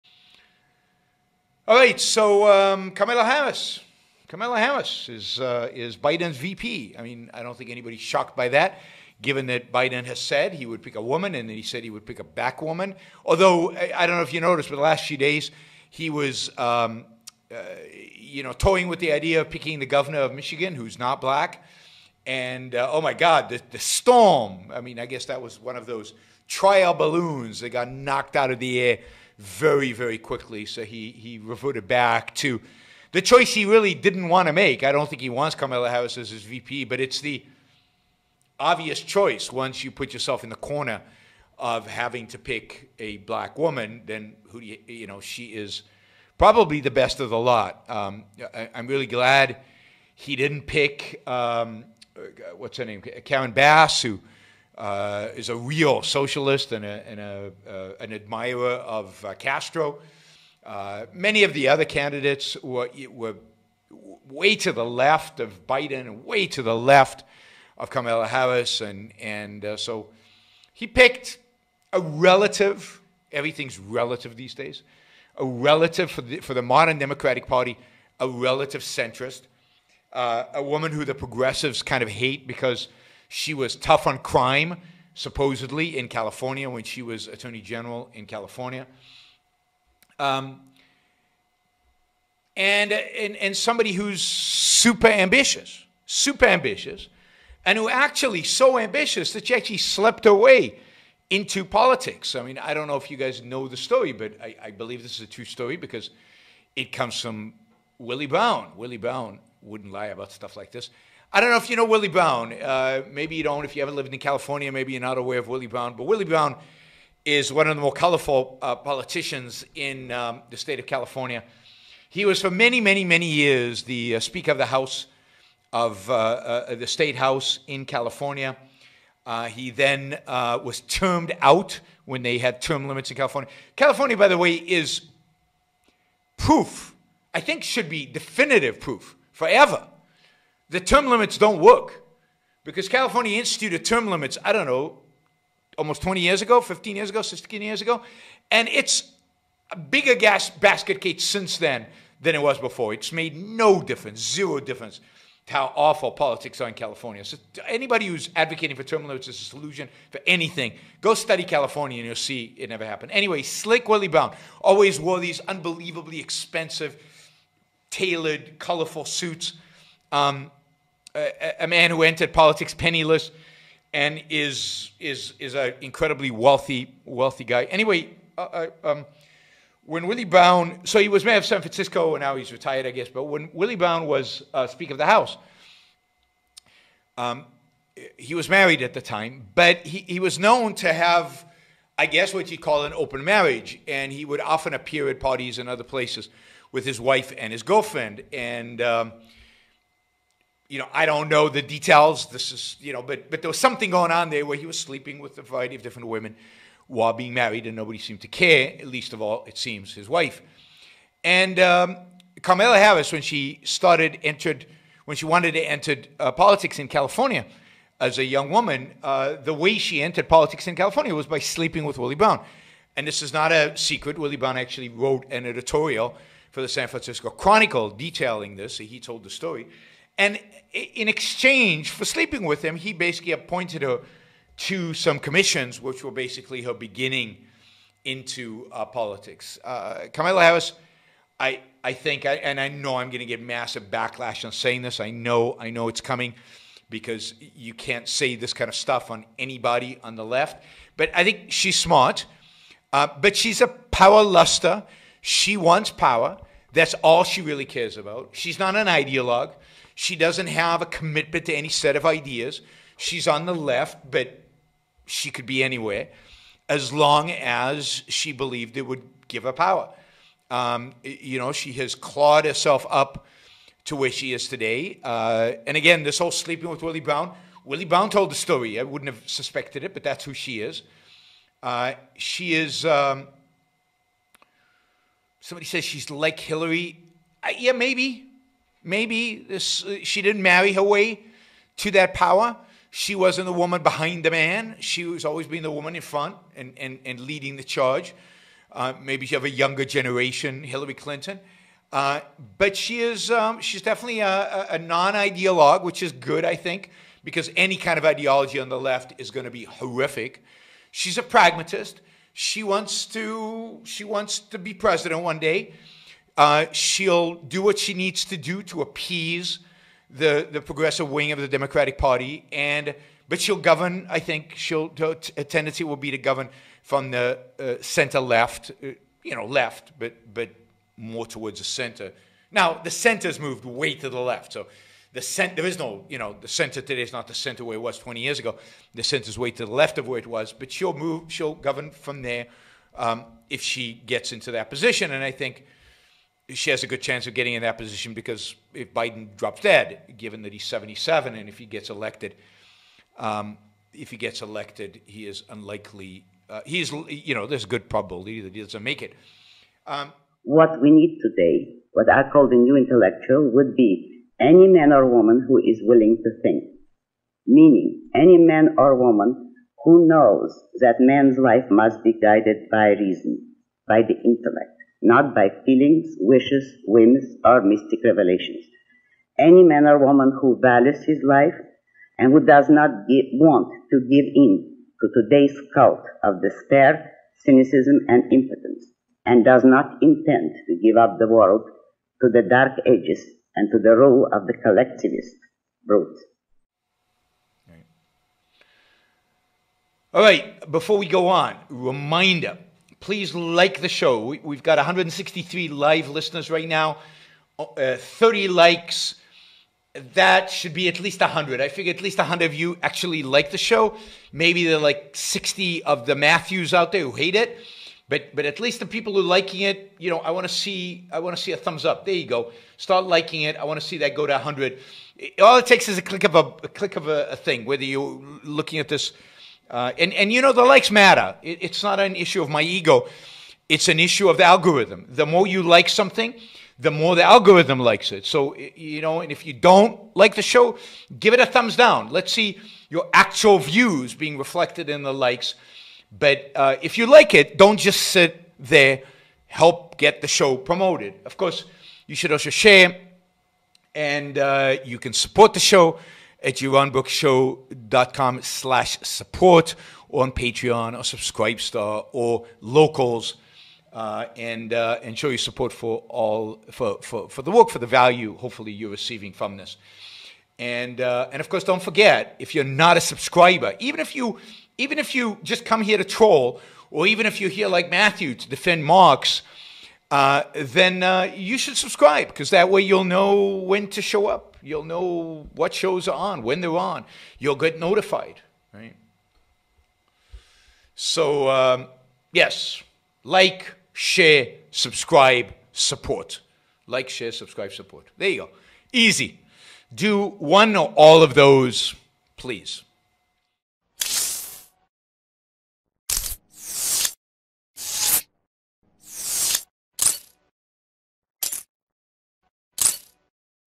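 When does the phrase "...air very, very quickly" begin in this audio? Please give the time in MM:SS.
00:28.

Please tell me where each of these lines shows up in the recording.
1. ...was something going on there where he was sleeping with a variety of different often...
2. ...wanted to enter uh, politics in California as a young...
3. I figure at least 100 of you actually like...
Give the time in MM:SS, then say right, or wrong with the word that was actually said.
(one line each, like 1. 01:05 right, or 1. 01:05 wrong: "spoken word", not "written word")
1. 03:23 wrong: "women", not "often"
2. 03:35 right
3. 06:51 right.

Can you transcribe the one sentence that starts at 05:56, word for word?
Uh, he's, you know, there's a good probability that he doesn't make it.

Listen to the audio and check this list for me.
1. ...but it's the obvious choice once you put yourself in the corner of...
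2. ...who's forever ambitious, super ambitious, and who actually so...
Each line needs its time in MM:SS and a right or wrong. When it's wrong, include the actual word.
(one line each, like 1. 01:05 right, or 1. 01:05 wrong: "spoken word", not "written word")
1. 00:36 right
2. 01:33 wrong: "super", not "forever".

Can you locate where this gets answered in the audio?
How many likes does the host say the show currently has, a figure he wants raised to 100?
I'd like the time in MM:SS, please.
06:47.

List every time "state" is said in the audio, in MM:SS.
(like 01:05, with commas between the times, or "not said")
02:00, 02:06.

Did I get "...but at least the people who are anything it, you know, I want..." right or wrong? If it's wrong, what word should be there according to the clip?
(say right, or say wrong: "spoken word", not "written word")
wrong: "liking", not "anything".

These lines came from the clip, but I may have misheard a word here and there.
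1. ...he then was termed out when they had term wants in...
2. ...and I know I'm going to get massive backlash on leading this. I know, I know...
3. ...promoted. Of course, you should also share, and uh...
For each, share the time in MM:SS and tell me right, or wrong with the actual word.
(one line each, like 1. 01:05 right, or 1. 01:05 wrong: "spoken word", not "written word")
1. 02:09 wrong: "limits", not "wants"
2. 04:02 wrong: "saying", not "leading"
3. 07:30 right.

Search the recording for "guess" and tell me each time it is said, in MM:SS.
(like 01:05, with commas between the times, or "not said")
00:25, 03:02, 03:12.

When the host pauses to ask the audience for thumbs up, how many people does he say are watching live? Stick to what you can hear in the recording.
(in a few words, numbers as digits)
163.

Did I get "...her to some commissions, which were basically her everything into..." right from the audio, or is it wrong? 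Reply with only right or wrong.
wrong.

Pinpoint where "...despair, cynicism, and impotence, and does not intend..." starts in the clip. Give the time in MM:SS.
06:26.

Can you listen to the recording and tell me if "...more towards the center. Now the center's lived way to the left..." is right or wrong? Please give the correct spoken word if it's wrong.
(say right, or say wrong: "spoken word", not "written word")
wrong: "moved", not "lived".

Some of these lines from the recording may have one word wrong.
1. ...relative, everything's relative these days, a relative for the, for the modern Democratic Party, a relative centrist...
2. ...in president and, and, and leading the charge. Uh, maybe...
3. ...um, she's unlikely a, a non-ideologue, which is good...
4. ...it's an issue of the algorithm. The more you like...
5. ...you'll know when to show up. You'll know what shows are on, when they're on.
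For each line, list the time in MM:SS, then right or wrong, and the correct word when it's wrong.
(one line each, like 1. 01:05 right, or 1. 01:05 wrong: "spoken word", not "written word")
1. 01:12 right
2. 04:55 wrong: "front", not "president"
3. 05:03 wrong: "definitely", not "unlikely"
4. 07:13 right
5. 08:02 right.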